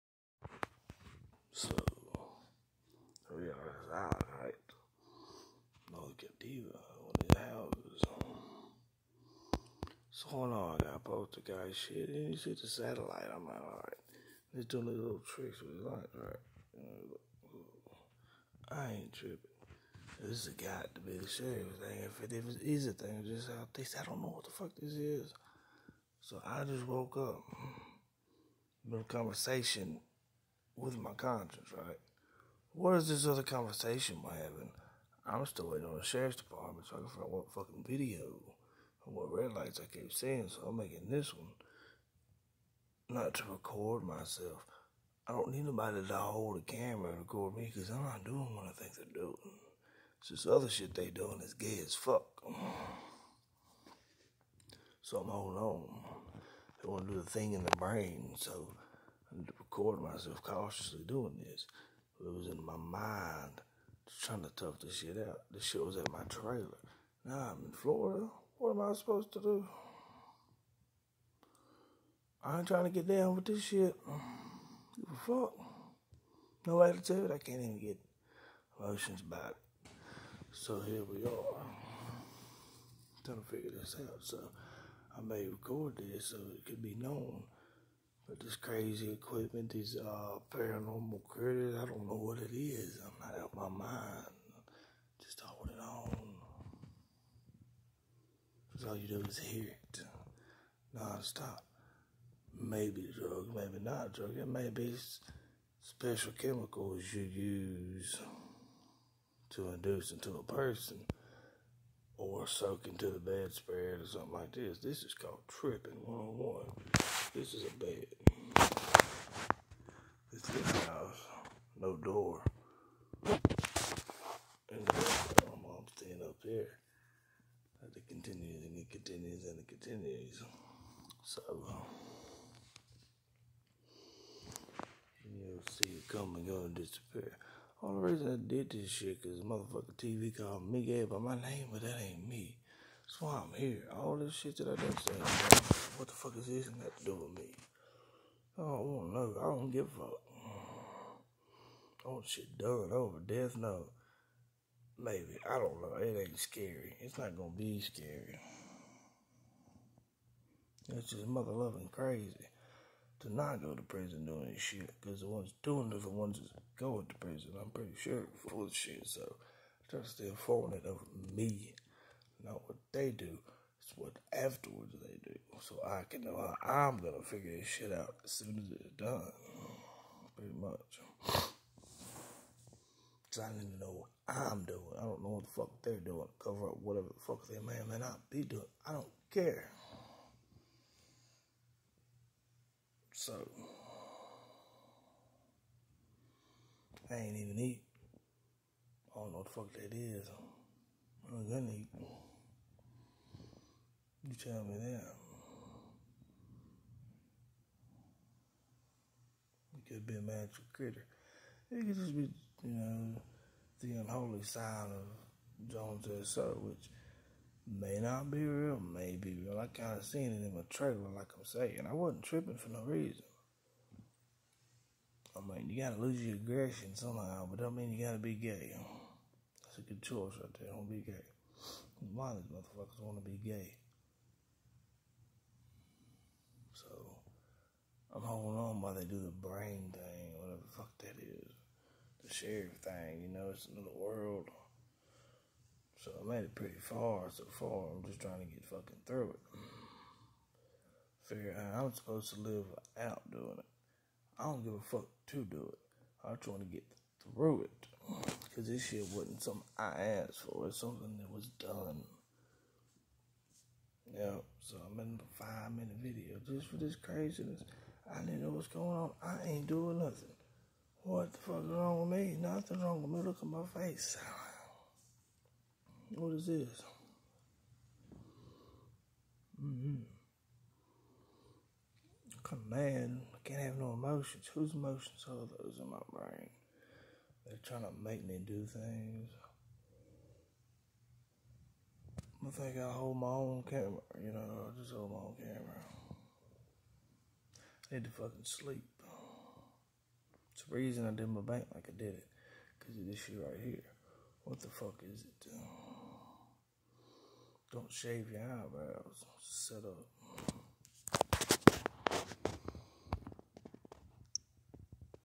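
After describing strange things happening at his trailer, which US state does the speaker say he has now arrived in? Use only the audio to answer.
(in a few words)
Florida.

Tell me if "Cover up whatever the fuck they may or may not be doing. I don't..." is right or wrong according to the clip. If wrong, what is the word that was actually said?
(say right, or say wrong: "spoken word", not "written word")
right.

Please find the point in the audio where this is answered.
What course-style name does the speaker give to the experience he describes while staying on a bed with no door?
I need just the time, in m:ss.
1:55.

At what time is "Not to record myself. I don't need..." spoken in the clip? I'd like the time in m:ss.
0:43.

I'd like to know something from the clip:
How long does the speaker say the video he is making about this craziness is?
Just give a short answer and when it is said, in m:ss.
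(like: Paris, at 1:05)
5 minutes, at 4:25.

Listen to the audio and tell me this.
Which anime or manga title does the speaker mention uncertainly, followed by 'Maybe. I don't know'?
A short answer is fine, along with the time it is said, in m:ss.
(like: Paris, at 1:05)
Death Note, at 2:33.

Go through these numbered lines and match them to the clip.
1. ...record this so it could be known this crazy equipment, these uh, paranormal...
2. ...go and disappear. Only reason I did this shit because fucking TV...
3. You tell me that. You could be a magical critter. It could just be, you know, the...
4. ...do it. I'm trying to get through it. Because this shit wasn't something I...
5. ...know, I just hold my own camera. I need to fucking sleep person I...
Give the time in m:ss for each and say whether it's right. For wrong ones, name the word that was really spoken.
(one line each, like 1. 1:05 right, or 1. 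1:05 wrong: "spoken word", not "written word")
1. 1:25 right
2. 2:16 wrong: "motherfucking", not "fucking"
3. 3:24 right
4. 4:15 right
5. 4:54 wrong: "reason", not "person".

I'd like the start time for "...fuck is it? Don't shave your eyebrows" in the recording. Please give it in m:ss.
5:04.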